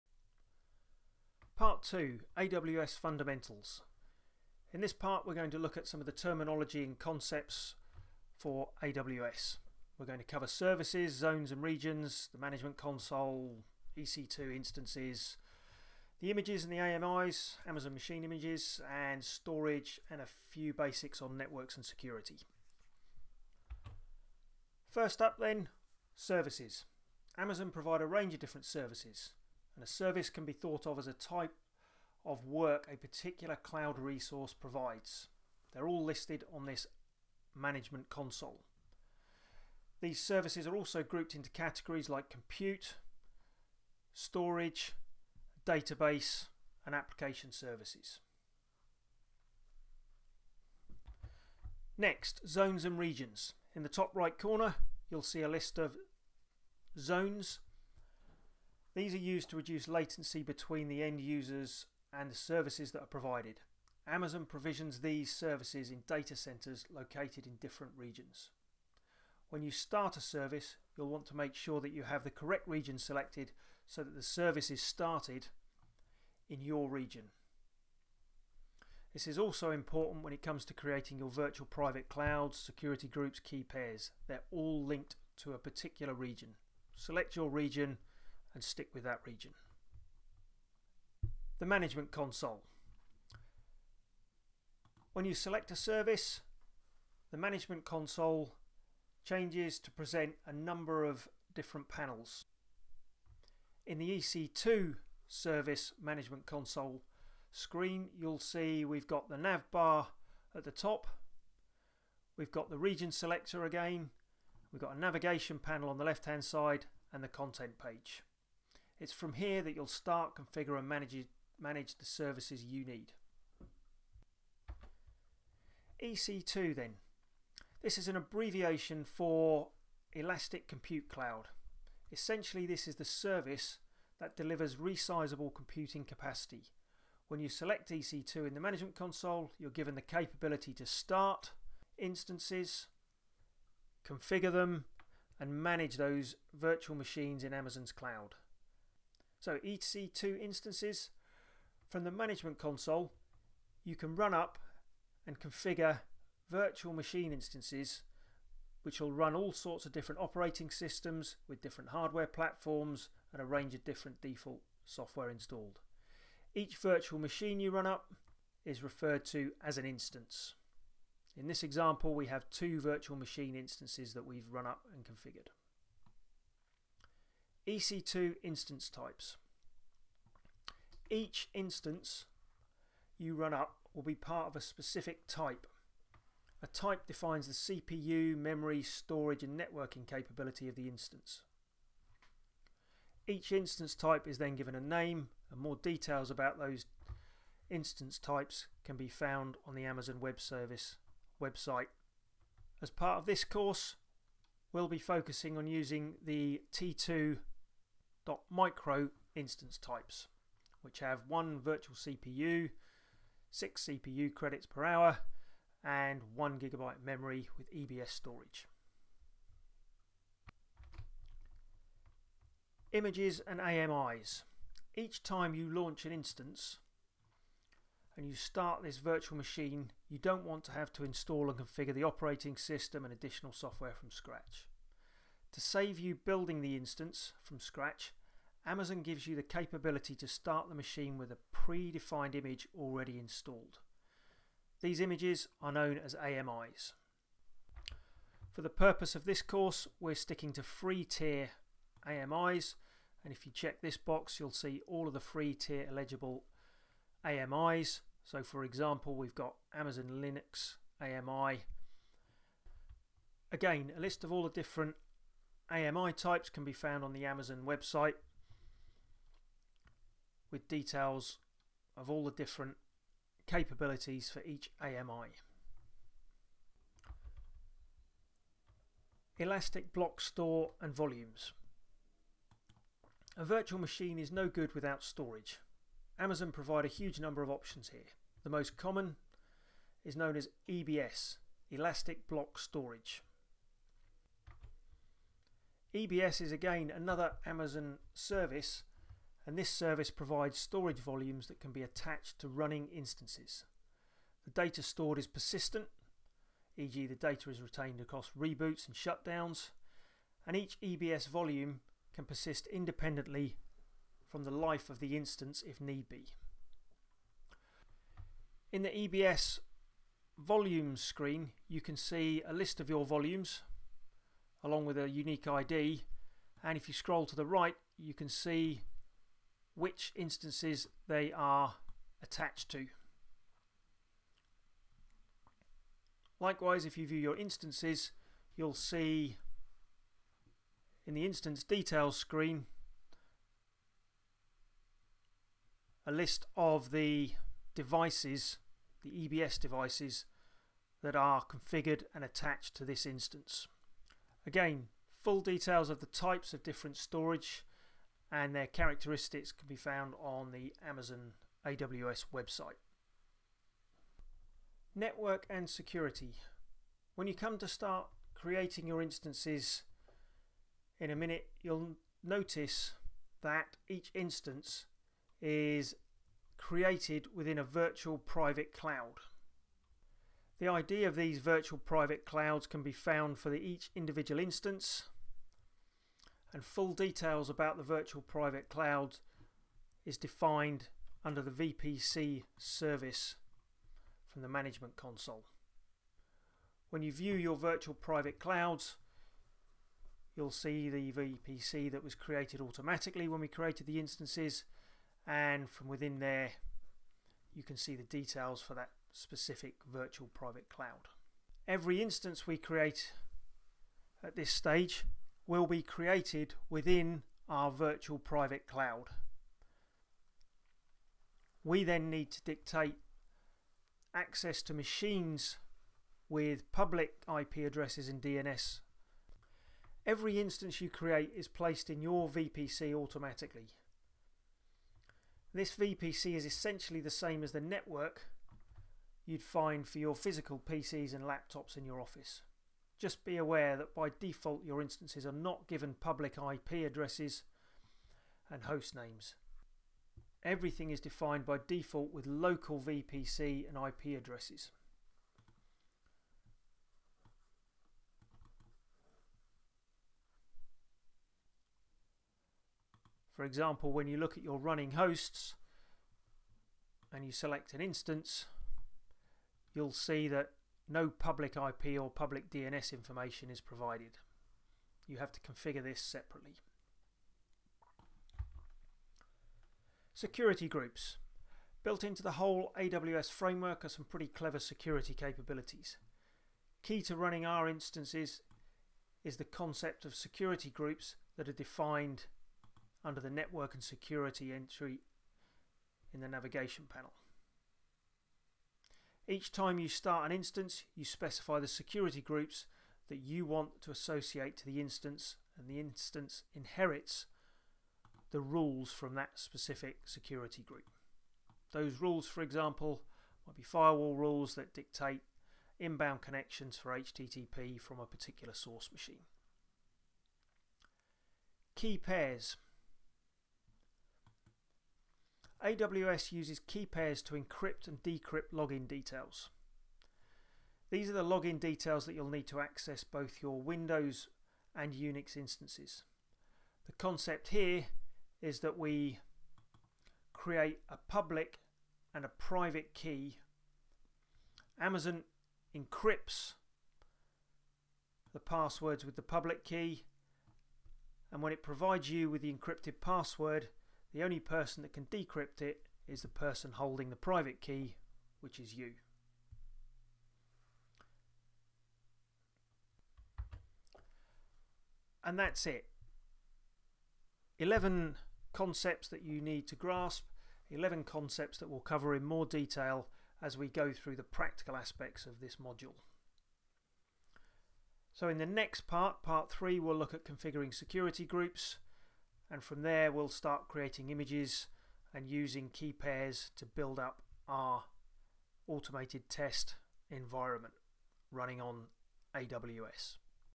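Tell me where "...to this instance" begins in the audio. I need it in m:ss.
5:52.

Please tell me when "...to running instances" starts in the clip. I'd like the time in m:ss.
5:02.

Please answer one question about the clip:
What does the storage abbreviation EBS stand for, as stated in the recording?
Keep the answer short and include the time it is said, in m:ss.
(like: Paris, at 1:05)
Elastic Block Storage, at 4:51.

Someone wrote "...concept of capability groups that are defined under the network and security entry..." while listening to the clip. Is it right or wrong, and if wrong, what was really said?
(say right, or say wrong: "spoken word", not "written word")
wrong: "security", not "capability".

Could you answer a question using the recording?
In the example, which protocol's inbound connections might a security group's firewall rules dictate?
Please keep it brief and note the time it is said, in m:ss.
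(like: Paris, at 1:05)
HTTP, at 8:36.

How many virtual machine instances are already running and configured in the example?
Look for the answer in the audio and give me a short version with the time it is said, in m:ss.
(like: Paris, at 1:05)
2, at 2:52.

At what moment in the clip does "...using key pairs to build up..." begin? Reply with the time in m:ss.
9:45.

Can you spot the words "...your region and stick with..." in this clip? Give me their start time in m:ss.
1:27.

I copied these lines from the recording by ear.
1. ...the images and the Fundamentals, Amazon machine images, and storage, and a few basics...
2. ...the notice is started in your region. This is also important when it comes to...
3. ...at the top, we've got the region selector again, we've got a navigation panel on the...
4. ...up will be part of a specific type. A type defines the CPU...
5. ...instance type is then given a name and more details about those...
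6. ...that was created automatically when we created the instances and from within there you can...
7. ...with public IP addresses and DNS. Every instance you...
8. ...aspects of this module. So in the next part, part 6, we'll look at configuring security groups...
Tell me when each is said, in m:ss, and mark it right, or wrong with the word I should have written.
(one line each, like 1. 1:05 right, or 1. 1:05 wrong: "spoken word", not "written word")
1. 0:16 wrong: "AMIs", not "Fundamentals"
2. 1:14 wrong: "service", not "notice"
3. 1:50 right
4. 3:03 right
5. 3:13 right
6. 6:41 right
7. 7:06 right
8. 9:34 wrong: "3", not "6".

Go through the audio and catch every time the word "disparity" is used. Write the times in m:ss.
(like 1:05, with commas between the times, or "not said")
not said.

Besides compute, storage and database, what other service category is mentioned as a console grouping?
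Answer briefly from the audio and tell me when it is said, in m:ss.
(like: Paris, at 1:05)
Application services, at 0:46.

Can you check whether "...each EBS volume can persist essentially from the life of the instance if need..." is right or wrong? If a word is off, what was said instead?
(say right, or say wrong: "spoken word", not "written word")
wrong: "independently", not "essentially".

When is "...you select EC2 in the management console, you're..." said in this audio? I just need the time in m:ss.
2:17.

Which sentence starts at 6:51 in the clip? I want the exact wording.
Every instance we create at this stage will be created within our virtual private cloud.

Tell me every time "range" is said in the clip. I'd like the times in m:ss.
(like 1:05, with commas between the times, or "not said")
0:28, 2:43.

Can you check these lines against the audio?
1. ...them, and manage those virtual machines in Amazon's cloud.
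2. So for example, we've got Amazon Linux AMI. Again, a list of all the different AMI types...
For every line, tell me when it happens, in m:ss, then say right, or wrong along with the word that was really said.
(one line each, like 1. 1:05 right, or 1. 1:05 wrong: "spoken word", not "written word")
1. 2:24 right
2. 4:18 right.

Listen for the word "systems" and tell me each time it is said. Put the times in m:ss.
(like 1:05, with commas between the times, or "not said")
2:40, 3:52.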